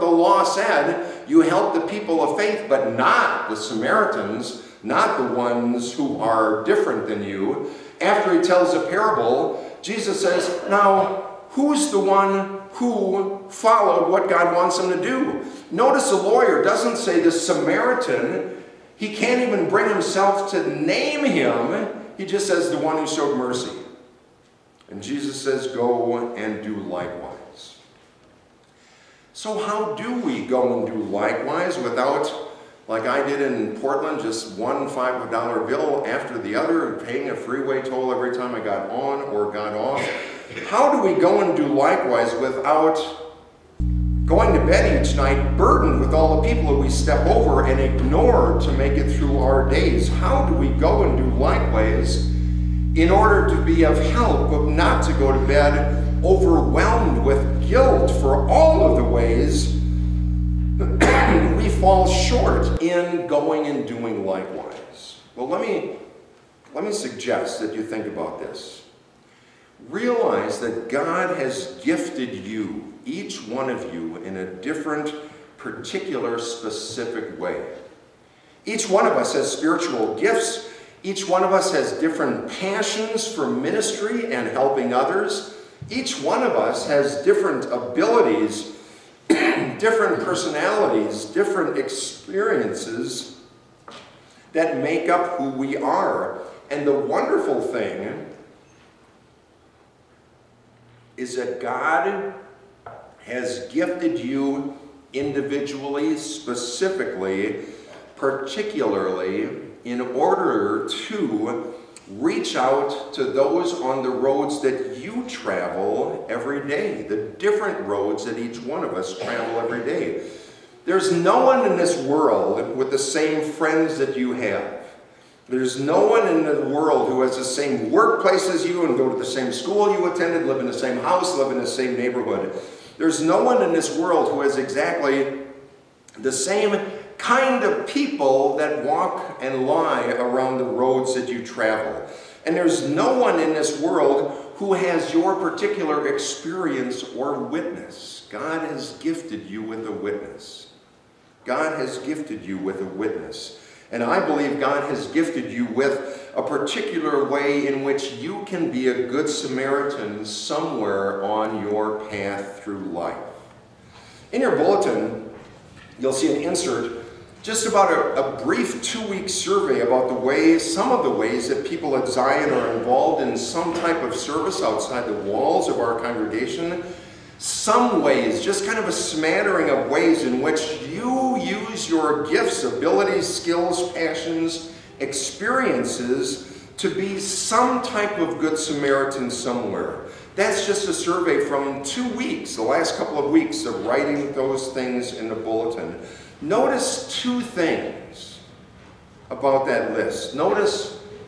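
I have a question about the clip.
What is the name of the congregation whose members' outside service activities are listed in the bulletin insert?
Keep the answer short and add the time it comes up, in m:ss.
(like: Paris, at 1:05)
Zion, at 2:52.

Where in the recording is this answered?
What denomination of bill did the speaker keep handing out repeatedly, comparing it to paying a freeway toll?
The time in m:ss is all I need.
0:34.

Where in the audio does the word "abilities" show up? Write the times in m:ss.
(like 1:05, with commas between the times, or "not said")
1:27, 3:02.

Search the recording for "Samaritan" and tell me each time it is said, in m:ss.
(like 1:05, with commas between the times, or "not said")
0:03, 0:17, 2:39, 3:08.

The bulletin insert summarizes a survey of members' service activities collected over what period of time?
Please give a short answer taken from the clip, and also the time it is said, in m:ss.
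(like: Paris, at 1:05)
two weeks, at 2:48.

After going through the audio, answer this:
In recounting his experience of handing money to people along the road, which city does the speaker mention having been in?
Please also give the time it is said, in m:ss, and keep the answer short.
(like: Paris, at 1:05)
Portland, at 0:33.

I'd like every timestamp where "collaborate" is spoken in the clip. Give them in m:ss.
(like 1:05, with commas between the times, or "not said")
not said.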